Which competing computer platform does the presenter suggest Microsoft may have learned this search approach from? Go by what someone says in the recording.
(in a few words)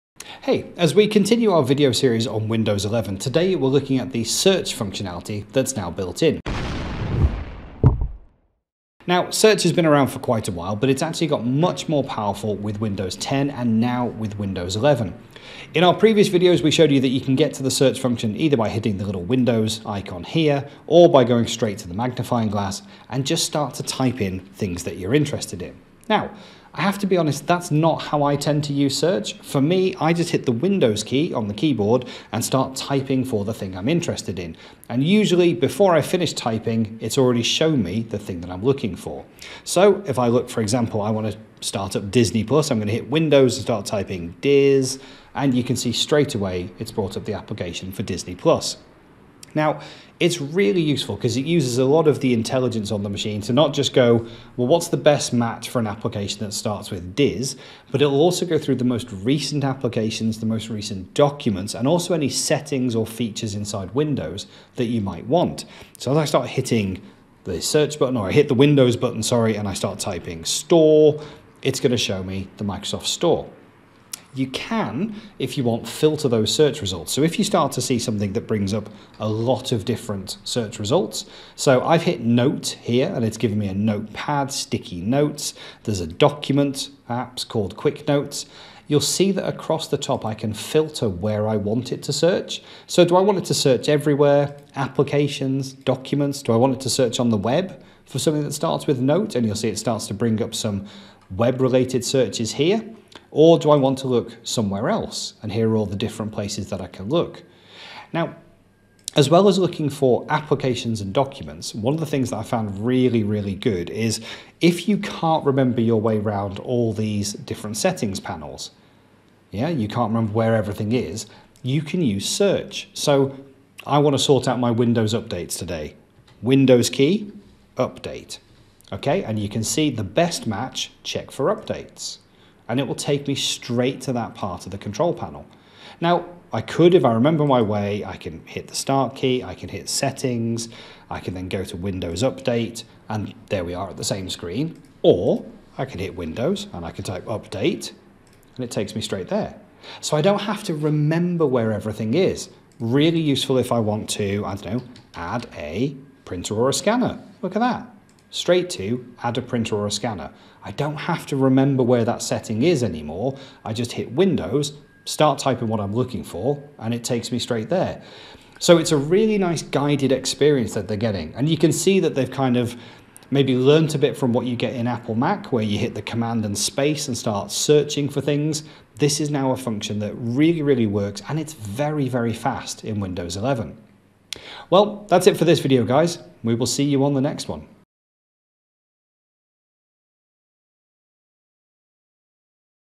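Apple Mac.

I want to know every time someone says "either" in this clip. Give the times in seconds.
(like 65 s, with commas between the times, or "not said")
18 s.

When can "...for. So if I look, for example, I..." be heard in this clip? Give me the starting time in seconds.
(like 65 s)
38 s.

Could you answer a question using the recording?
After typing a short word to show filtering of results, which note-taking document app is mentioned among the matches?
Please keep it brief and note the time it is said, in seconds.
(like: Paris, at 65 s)
Quick Notes, at 87 s.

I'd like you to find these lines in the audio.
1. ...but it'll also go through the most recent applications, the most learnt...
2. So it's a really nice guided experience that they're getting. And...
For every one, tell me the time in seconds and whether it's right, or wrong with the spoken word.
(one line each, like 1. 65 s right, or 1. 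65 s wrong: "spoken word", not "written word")
1. 57 s wrong: "recent", not "learnt"
2. 168 s right.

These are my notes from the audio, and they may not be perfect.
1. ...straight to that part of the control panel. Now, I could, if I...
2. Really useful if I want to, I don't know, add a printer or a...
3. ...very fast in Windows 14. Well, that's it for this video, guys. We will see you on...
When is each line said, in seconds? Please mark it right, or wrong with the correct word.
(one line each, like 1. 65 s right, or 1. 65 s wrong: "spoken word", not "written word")
1. 133 s right
2. 152 s right
3. 182 s wrong: "11", not "14".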